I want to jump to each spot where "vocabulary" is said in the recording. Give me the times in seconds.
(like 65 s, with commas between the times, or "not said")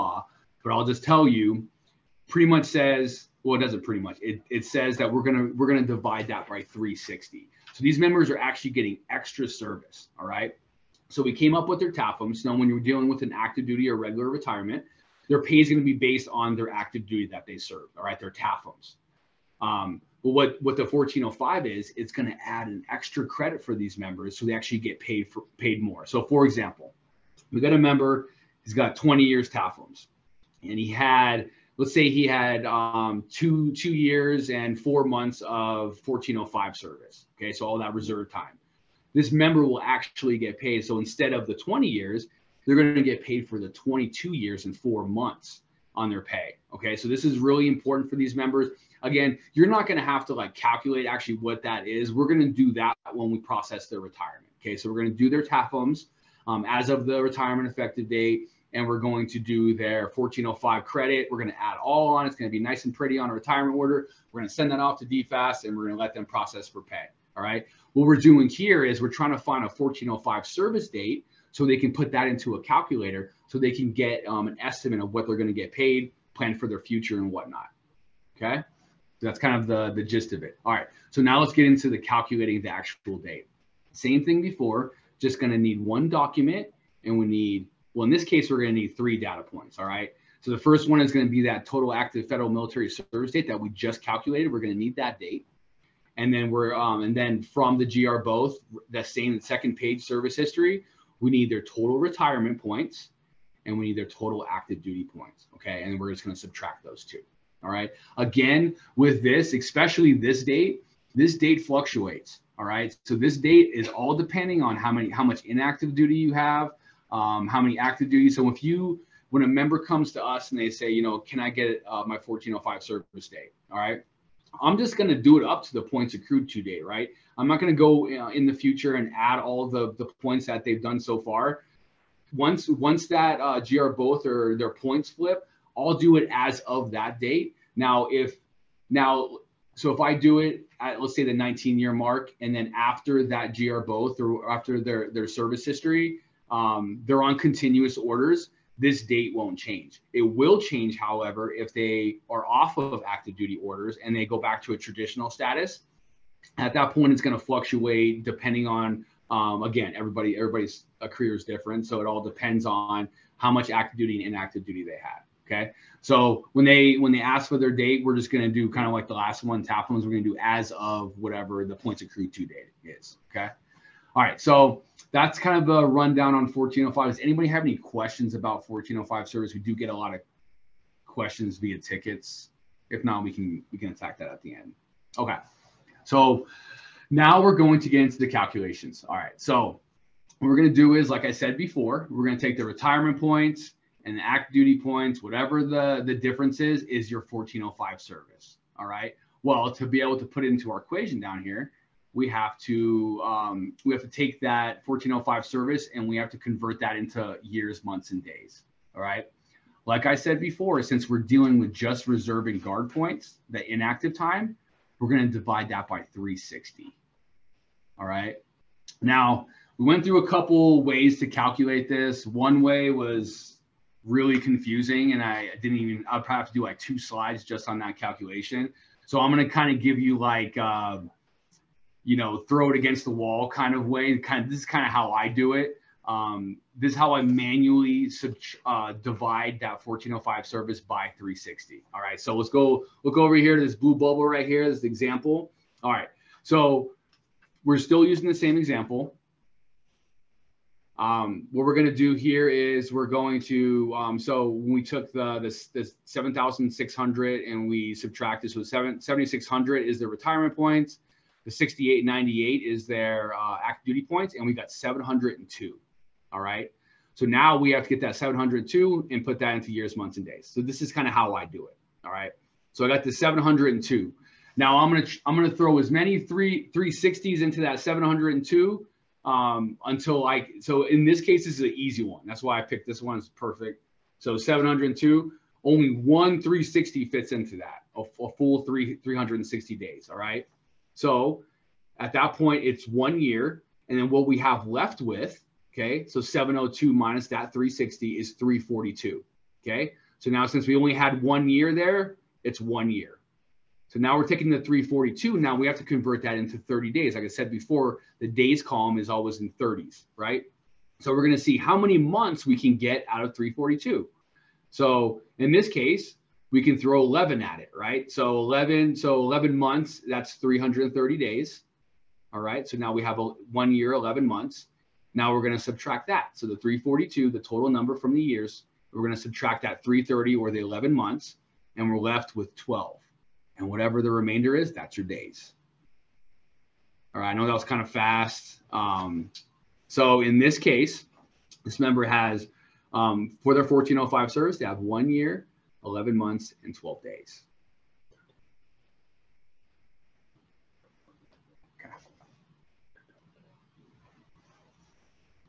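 not said.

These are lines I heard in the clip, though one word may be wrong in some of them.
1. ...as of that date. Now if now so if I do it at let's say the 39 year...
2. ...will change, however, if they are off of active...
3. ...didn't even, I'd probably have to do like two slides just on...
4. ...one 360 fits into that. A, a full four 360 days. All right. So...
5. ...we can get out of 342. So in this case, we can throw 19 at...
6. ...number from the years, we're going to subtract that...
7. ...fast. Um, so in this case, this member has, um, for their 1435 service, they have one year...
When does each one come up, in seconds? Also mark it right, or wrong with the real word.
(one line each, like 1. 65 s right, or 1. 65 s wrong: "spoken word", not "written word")
1. 136 s wrong: "19", not "39"
2. 150 s right
3. 225 s right
4. 285 s wrong: "three", not "four"
5. 312 s wrong: "11", not "19"
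6. 327 s right
7. 337 s wrong: "1405", not "1435".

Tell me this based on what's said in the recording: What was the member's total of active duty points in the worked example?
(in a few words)
6,898.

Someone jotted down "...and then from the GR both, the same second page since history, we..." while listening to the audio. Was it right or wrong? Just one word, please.
wrong.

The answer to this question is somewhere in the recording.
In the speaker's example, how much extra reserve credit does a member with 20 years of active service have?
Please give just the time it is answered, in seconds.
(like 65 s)
33 s.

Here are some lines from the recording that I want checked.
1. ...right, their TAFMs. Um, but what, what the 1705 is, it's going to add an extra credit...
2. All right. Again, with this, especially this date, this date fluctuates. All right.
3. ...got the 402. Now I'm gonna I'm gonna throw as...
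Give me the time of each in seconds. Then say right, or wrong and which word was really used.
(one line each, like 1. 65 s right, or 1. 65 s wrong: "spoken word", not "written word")
1. 18 s wrong: "1405", not "1705"
2. 107 s right
3. 272 s wrong: "702", not "402".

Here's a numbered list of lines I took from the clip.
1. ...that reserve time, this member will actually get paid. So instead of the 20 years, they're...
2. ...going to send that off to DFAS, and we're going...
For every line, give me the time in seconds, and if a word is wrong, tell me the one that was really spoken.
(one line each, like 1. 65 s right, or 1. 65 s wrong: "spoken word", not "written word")
1. 37 s right
2. 64 s right.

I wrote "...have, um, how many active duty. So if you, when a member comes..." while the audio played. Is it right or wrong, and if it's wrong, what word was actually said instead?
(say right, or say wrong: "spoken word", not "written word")
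right.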